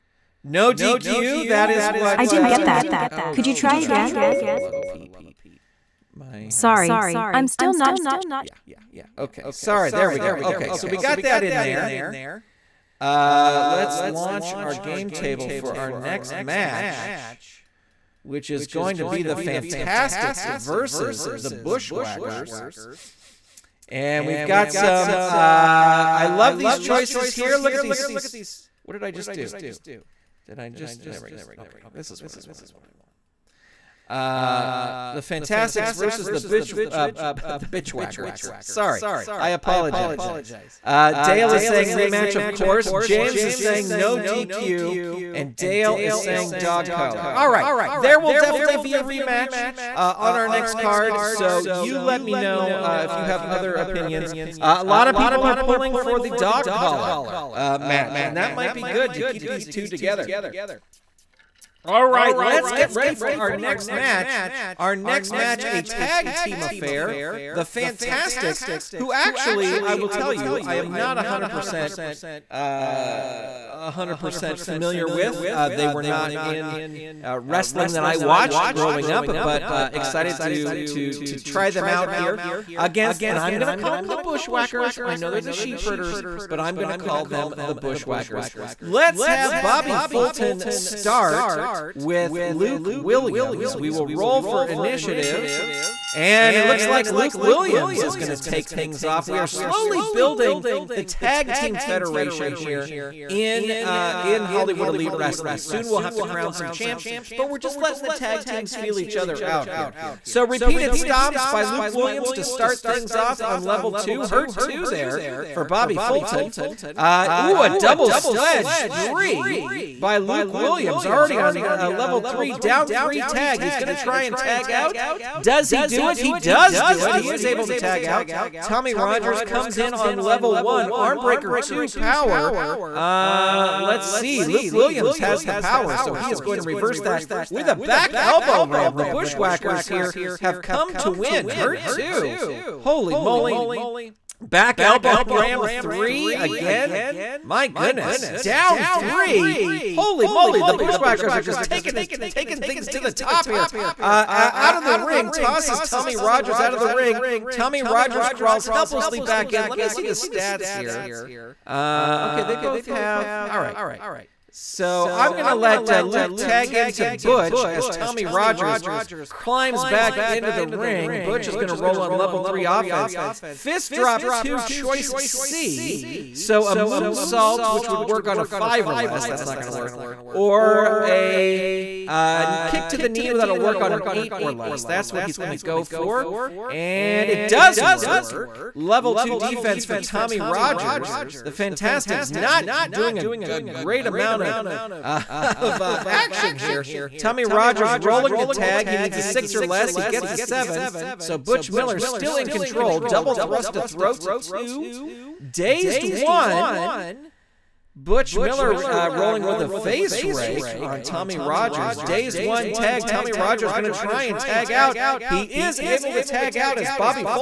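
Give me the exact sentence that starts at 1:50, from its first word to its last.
So repeated stomps by Luke Williams to start things off on level two.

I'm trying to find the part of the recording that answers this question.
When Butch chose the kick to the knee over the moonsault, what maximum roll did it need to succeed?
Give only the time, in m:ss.
3:04.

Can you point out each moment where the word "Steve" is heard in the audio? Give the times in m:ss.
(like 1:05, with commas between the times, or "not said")
not said.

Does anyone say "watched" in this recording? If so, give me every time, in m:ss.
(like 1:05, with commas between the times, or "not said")
1:18.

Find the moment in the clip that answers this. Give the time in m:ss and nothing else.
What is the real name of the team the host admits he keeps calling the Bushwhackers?
1:25.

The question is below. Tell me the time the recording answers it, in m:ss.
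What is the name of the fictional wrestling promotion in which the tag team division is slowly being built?
1:44.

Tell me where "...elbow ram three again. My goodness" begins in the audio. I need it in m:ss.
2:24.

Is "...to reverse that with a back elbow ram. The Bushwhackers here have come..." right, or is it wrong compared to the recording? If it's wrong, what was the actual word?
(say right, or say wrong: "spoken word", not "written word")
right.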